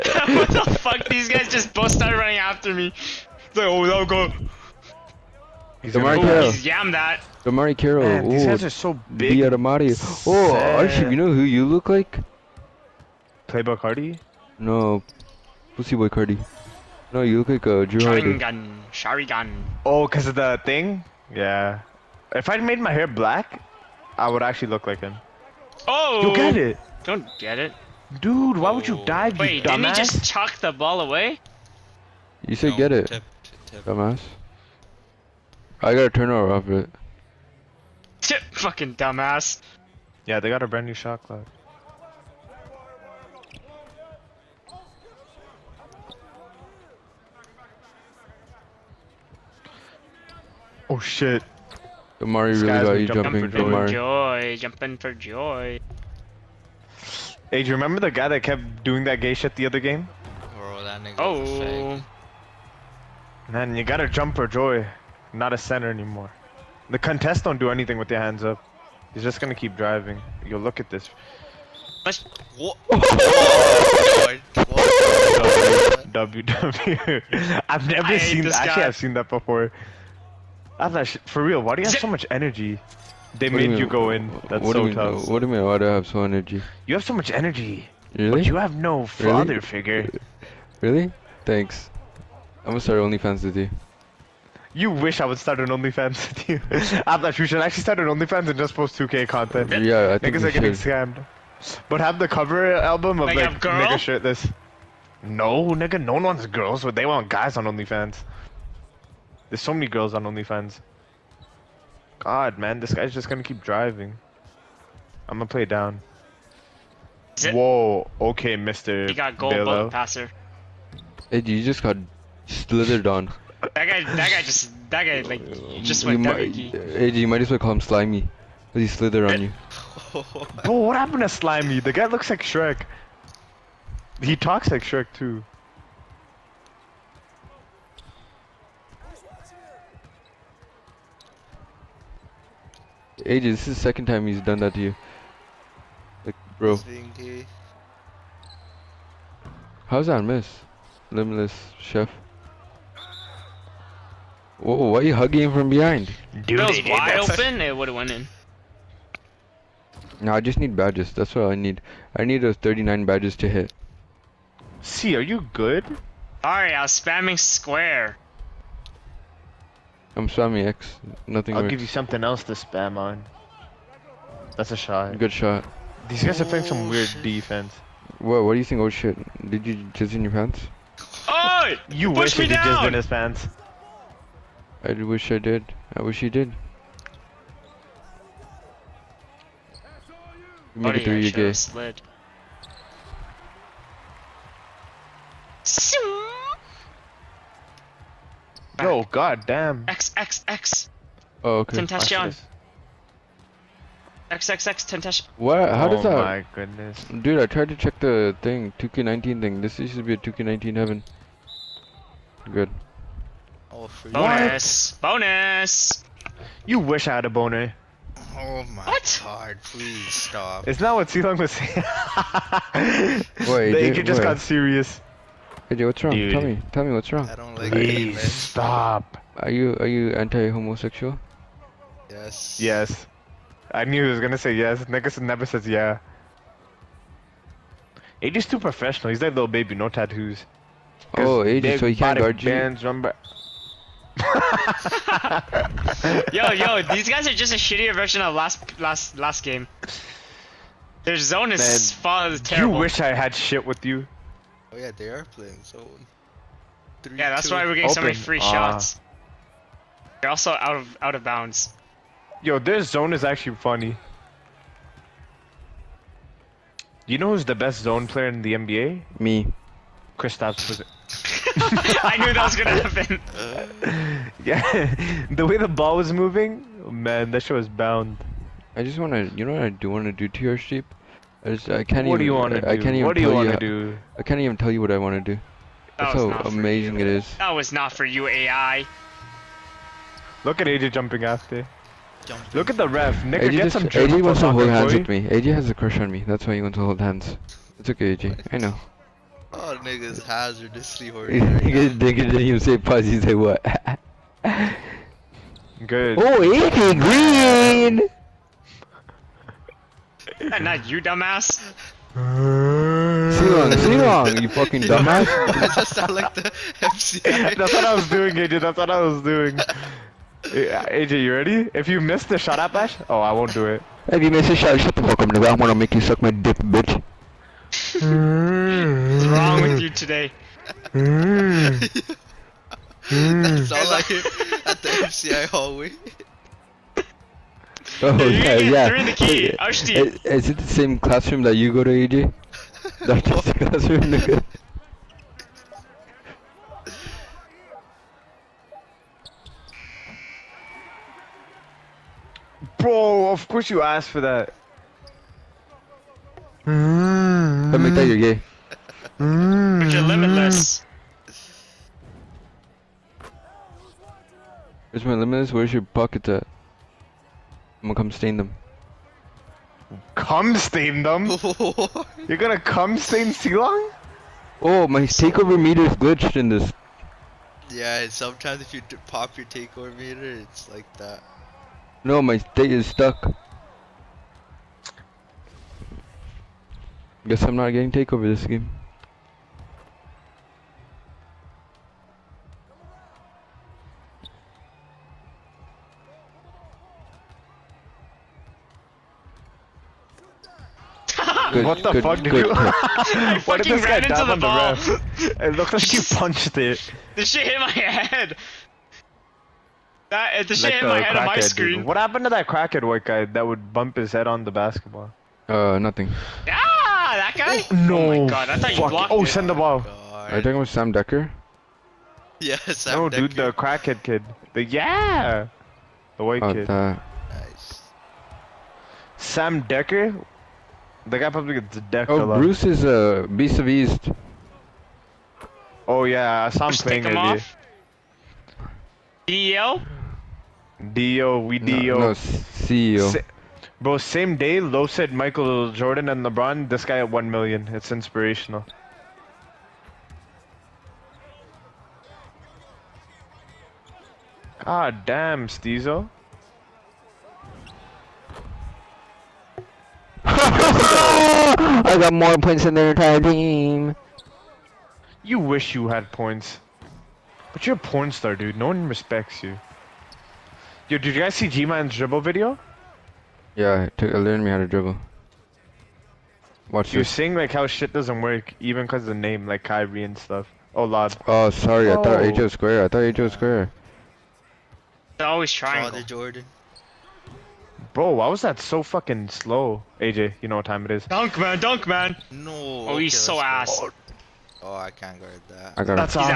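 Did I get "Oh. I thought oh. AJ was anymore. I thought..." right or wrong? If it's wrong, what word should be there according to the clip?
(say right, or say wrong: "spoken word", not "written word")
wrong: "square", not "anymore".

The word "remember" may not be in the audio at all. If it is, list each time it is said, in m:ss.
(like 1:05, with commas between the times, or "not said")
0:57, 4:02.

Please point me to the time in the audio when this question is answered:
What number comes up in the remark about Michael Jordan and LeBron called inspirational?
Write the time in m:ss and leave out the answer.
7:27.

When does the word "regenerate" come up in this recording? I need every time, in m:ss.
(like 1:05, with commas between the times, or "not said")
not said.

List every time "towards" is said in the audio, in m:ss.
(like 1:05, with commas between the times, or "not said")
not said.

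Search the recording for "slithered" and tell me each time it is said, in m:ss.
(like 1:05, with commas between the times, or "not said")
2:02, 2:08.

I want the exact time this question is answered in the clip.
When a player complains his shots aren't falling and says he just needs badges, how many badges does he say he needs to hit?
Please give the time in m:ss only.
2:42.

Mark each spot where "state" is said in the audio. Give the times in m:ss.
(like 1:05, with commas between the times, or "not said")
6:22.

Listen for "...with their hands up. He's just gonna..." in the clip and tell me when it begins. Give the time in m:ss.
1:07.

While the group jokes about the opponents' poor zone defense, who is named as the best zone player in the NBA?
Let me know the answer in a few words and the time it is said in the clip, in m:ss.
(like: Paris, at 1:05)
Kristaps, at 4:30.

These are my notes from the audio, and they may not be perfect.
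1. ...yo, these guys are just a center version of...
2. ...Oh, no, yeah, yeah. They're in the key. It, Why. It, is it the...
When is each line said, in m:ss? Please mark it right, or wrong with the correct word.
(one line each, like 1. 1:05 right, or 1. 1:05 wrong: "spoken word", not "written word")
1. 4:06 wrong: "shittier", not "center"
2. 5:38 wrong: "Ashti", not "Why".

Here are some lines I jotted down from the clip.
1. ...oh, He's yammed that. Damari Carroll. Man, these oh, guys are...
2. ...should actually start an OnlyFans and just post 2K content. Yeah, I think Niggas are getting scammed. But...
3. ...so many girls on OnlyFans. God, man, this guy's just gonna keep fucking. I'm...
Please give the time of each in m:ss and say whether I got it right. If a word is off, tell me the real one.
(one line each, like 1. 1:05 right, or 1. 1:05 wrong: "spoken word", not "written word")
1. 0:06 right
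2. 1:37 right
3. 1:49 wrong: "driving", not "fucking".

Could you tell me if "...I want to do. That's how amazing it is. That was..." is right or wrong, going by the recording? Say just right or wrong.
right.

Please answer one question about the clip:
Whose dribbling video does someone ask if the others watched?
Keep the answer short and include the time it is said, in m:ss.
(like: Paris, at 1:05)
G-Man, at 7:51.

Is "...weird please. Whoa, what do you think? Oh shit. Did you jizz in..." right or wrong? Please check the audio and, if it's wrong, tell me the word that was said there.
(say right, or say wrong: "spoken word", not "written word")
wrong: "defense", not "please".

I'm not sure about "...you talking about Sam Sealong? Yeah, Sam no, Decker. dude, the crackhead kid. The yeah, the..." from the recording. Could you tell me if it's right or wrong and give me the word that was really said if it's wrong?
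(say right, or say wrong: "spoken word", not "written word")
wrong: "Decker", not "Sealong".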